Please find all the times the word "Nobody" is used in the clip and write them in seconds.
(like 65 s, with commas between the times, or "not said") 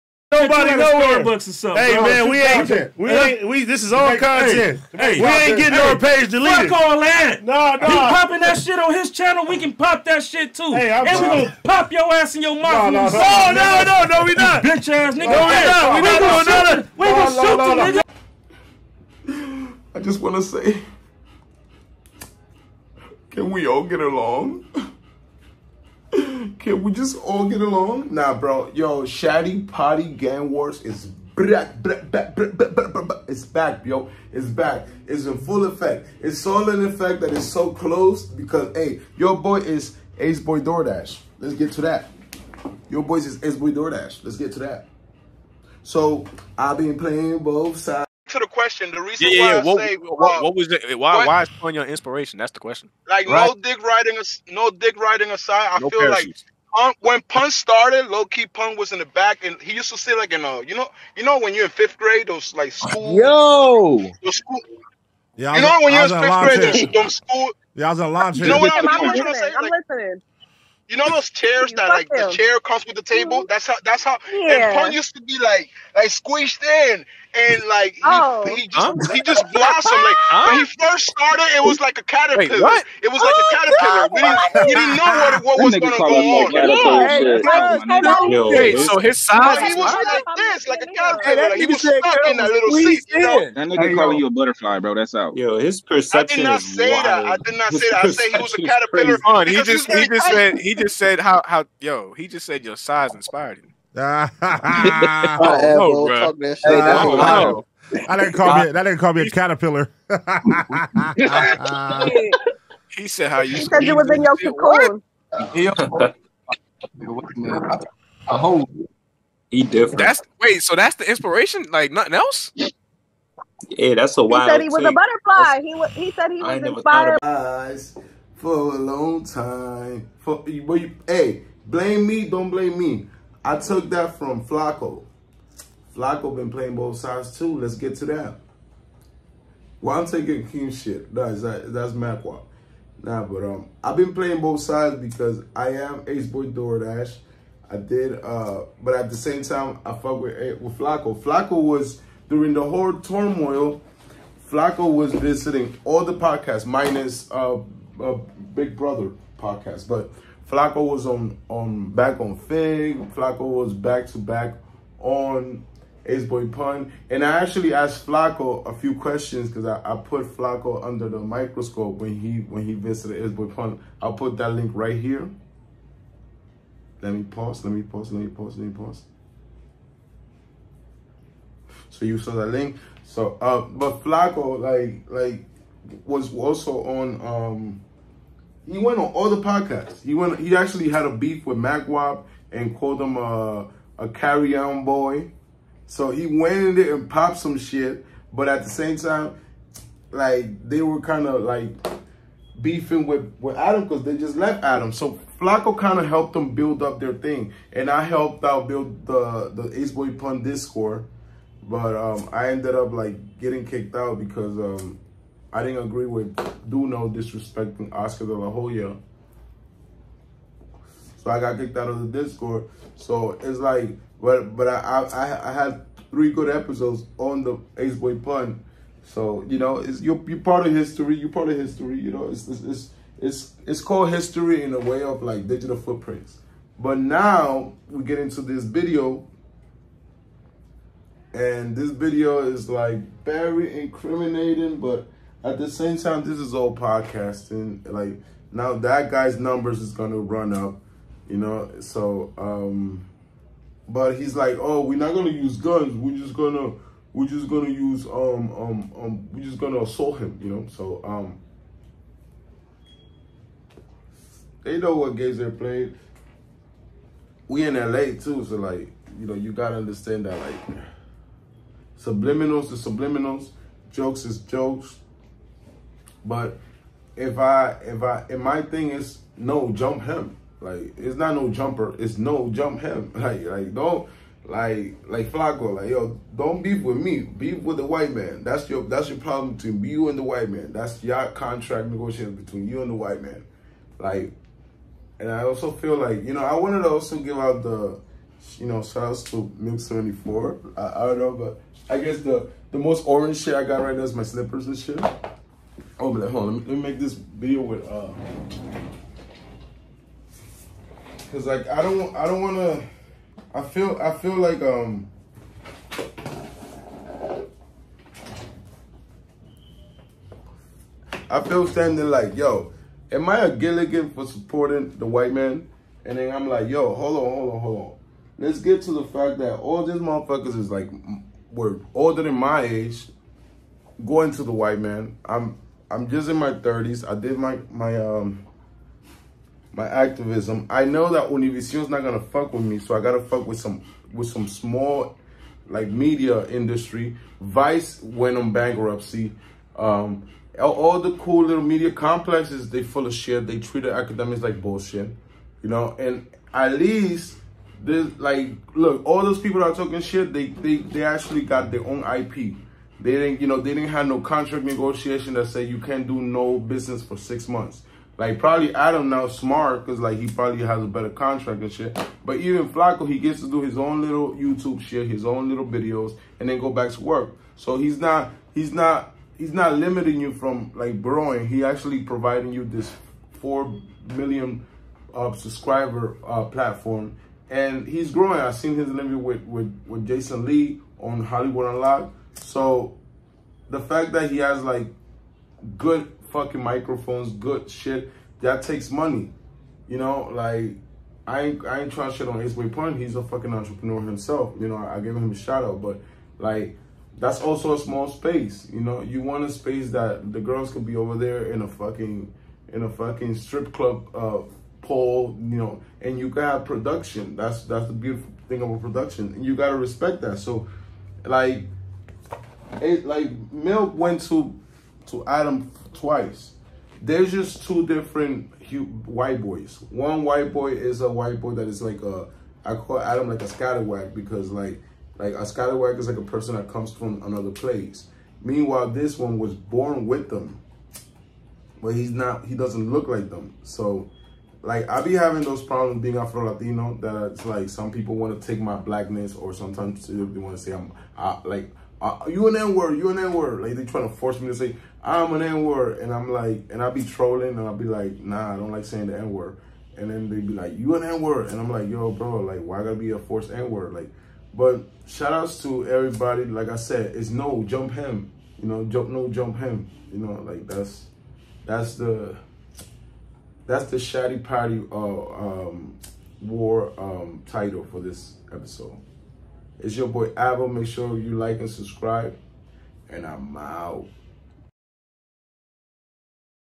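0 s.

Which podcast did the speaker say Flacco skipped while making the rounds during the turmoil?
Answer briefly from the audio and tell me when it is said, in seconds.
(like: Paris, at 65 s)
Big Brother podcast, at 158 s.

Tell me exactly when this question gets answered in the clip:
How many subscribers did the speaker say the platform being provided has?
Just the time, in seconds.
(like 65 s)
383 s.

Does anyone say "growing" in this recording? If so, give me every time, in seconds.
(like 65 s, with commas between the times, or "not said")
381 s, 388 s.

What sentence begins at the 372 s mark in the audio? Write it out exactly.
But even Flacco, he gets to do his own little YouTube shit, his own little videos, and then go back to work.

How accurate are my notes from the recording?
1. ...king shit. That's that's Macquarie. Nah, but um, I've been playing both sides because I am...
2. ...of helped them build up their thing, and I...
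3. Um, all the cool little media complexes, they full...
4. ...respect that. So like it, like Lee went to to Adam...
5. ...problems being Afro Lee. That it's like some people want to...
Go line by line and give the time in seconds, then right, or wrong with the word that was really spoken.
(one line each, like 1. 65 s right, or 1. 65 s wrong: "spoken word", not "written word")
1. 140 s right
2. 205 s right
3. 349 s right
4. 419 s wrong: "Milk", not "Lee"
5. 445 s wrong: "Latino", not "Lee".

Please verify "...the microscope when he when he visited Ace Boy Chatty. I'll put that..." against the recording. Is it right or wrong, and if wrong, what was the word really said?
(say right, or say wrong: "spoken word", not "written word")
wrong: "Pun", not "Chatty".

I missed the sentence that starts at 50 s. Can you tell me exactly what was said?
Why what, why is Pun your inspiration?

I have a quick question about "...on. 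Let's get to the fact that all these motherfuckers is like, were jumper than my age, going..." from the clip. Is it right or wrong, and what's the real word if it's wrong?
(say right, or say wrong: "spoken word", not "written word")
wrong: "older", not "jumper".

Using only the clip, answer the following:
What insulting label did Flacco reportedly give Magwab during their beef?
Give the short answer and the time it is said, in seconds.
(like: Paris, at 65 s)
carry on boy, at 194 s.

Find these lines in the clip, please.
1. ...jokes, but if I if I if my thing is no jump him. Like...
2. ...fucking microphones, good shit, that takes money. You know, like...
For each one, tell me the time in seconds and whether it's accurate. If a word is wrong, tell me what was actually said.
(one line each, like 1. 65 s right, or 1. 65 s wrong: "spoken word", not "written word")
1. 274 s right
2. 396 s right.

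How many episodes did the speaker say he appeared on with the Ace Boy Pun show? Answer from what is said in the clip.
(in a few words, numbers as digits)
3.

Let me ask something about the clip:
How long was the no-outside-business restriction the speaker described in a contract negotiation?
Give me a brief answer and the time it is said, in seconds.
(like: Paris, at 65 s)
6 months, at 367 s.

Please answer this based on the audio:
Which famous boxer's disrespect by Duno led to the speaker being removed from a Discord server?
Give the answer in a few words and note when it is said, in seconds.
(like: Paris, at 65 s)
Oscar De La Hoya, at 217 s.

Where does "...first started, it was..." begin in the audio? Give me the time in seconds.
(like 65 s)
80 s.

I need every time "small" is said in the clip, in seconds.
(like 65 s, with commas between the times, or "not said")
344 s, 407 s.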